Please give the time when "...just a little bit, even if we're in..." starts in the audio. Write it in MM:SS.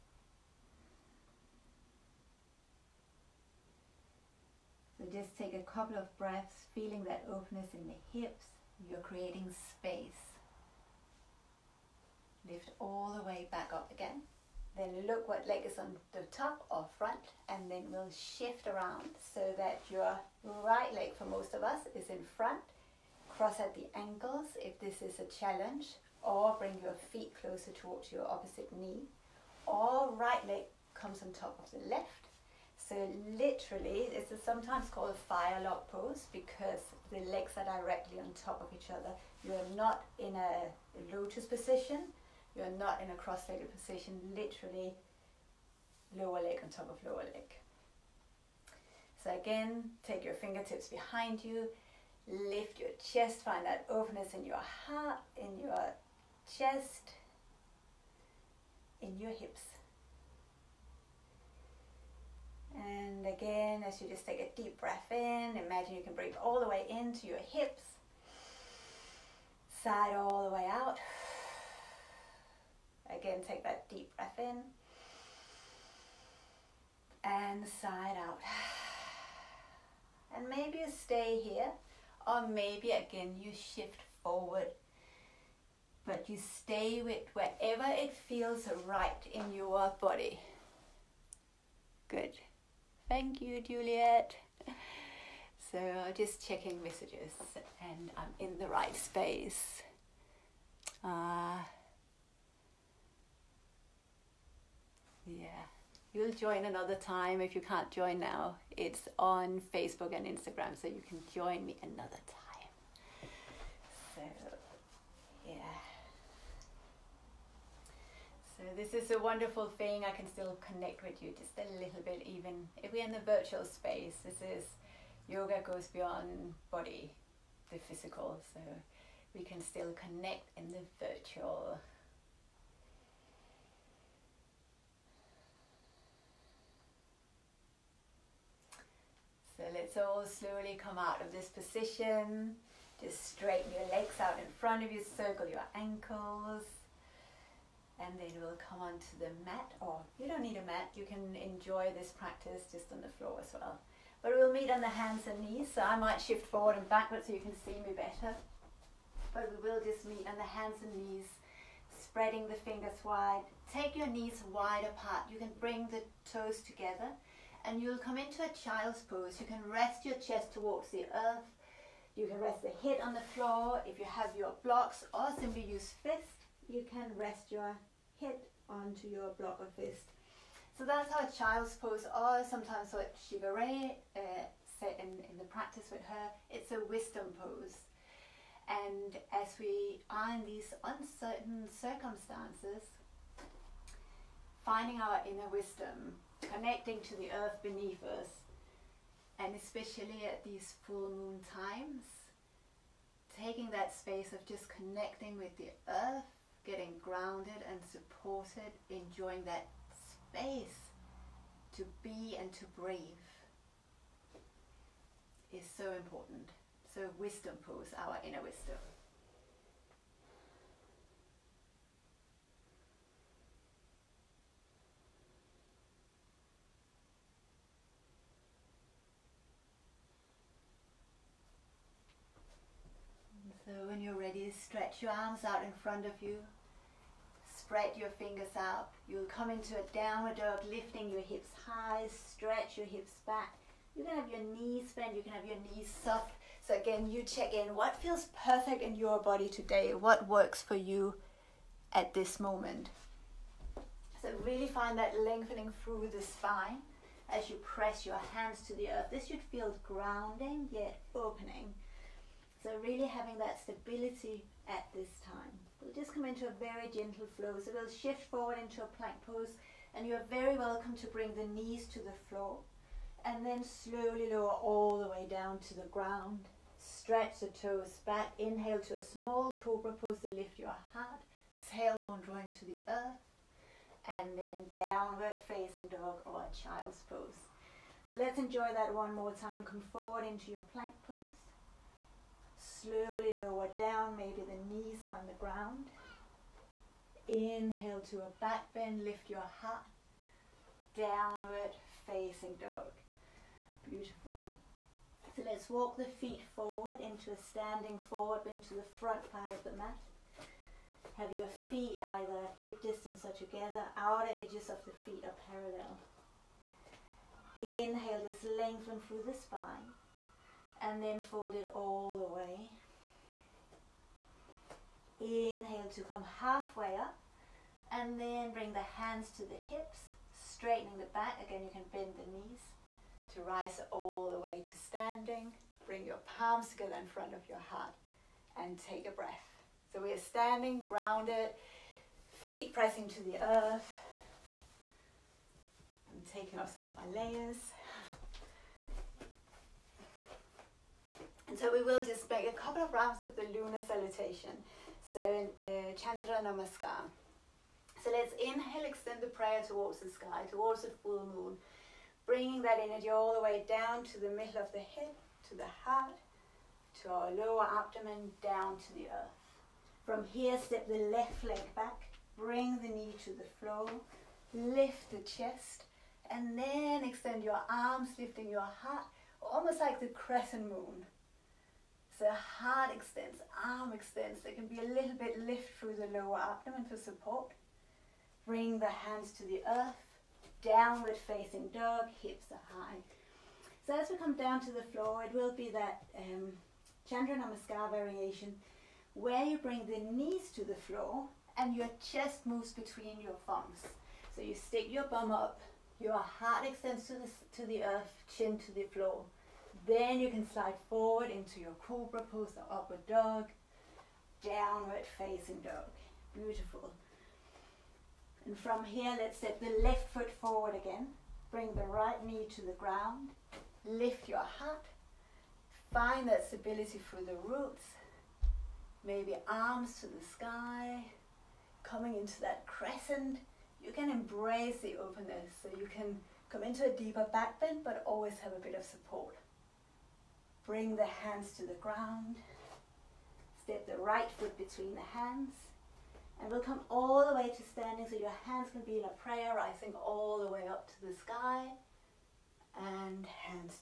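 02:01.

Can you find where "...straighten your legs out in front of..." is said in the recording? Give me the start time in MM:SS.
02:23.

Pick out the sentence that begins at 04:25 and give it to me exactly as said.
We'll just come into a very gentle flow.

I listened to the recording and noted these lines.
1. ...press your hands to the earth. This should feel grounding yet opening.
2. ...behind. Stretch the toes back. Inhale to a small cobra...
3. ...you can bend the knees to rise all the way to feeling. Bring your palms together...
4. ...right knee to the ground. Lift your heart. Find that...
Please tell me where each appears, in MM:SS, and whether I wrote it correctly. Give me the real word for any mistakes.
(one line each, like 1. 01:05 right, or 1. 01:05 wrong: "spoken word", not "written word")
1. 04:17 right
2. 04:35 wrong: "ground", not "behind"
3. 05:31 wrong: "standing", not "feeling"
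4. 07:01 right.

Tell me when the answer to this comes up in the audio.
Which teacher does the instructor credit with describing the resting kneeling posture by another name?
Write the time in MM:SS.
03:03.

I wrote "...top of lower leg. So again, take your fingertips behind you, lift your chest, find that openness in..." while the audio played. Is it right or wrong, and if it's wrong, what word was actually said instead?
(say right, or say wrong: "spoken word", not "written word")
right.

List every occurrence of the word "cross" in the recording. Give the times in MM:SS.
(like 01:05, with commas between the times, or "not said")
00:23, 00:43.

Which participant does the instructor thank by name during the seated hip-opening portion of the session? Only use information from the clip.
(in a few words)
Juliet.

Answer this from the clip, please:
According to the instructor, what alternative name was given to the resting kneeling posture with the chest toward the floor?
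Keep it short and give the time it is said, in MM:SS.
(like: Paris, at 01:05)
wisdom pose, at 03:06.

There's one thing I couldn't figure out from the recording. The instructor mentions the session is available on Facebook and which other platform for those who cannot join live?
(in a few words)
Instagram.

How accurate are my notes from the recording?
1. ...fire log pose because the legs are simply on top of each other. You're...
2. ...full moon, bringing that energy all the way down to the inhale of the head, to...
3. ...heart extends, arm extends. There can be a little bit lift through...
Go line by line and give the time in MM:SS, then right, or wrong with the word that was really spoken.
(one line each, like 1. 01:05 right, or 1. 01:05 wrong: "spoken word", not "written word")
1. 00:35 wrong: "directly", not "simply"
2. 06:01 wrong: "middle", not "inhale"
3. 06:22 right.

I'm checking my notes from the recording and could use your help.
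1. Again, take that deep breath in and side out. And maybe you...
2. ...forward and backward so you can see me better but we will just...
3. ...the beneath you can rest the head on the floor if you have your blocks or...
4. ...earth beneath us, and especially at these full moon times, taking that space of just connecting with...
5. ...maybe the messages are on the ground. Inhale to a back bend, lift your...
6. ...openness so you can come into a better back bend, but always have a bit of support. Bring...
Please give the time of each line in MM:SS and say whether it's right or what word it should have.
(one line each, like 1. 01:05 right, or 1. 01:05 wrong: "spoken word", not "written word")
1. 01:13 right
2. 02:36 right
3. 02:50 wrong: "earth", not "beneath"
4. 03:17 right
5. 04:54 wrong: "knees", not "messages"
6. 07:14 wrong: "deeper", not "better".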